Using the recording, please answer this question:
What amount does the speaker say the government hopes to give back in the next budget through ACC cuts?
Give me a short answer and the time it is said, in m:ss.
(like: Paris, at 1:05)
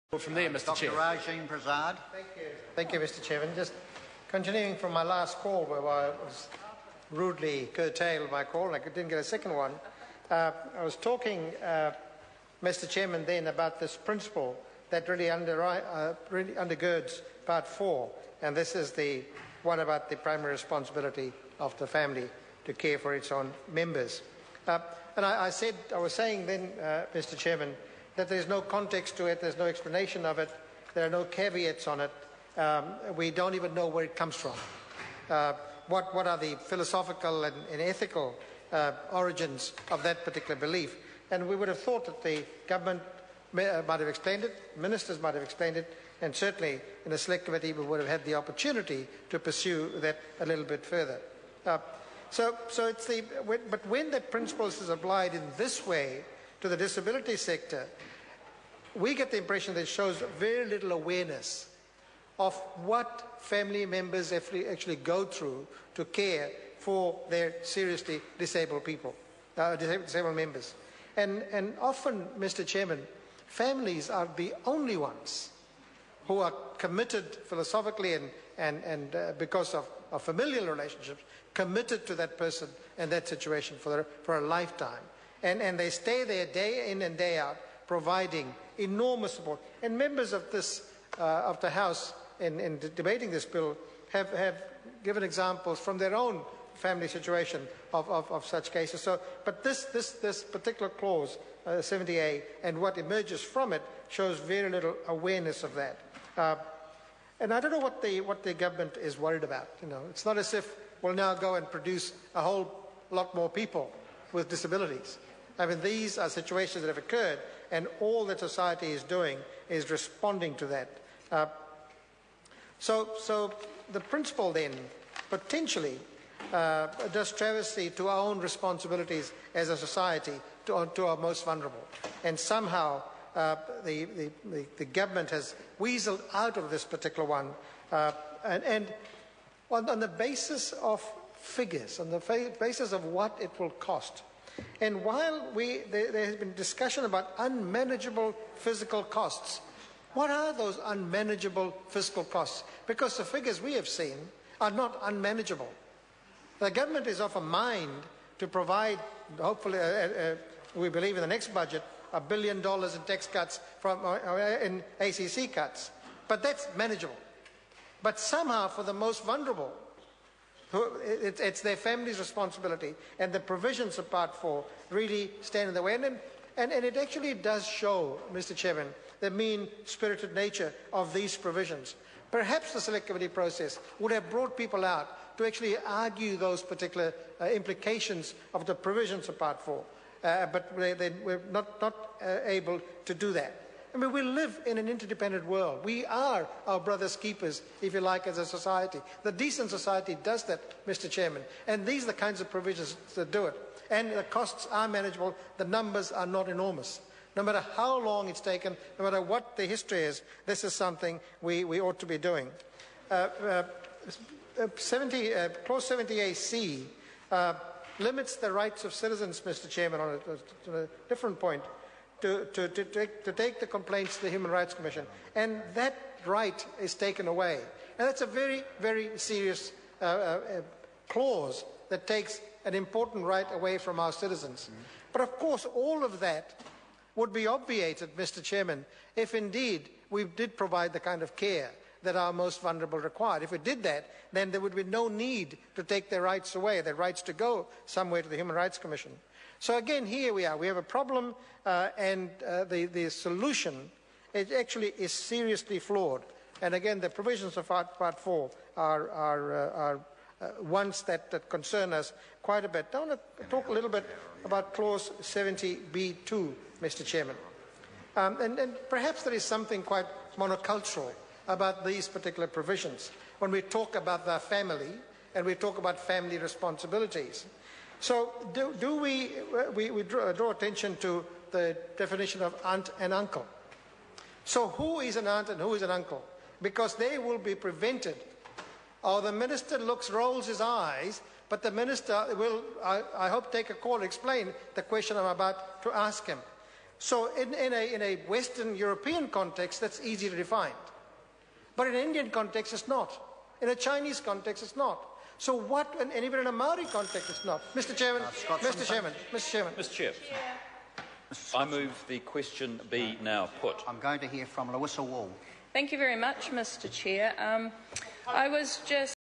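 a billion dollars, at 2:42.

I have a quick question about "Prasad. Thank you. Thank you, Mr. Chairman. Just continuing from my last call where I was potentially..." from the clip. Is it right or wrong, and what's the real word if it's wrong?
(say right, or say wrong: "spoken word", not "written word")
wrong: "rudely", not "potentially".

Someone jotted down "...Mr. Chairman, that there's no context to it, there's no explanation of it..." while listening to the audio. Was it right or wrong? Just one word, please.
right.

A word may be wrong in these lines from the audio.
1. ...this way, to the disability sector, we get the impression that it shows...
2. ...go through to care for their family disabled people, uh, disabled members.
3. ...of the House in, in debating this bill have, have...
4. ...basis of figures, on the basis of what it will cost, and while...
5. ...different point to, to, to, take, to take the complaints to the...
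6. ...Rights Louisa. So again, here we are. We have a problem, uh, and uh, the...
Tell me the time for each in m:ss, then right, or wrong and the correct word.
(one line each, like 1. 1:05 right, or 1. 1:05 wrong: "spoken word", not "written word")
1. 0:55 right
2. 1:04 wrong: "seriously", not "family"
3. 1:31 right
4. 2:20 right
5. 3:41 right
6. 4:08 wrong: "Commission", not "Louisa".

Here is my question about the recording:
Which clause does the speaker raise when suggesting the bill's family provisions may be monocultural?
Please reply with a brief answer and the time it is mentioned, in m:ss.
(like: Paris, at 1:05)
Clause 70B2, at 4:24.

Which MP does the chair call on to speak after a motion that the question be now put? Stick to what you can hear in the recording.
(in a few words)
Louisa Wall.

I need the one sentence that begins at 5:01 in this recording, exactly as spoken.
But in an Indian context, it's not.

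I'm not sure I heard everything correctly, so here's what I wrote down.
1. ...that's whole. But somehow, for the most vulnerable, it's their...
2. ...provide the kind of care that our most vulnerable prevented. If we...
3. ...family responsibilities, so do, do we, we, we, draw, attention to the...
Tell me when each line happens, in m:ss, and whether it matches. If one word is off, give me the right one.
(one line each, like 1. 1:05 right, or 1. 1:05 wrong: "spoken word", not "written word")
1. 2:46 wrong: "manageable", not "whole"
2. 4:00 wrong: "required", not "prevented"
3. 4:35 right.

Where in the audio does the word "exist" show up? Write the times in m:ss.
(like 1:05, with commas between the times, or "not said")
not said.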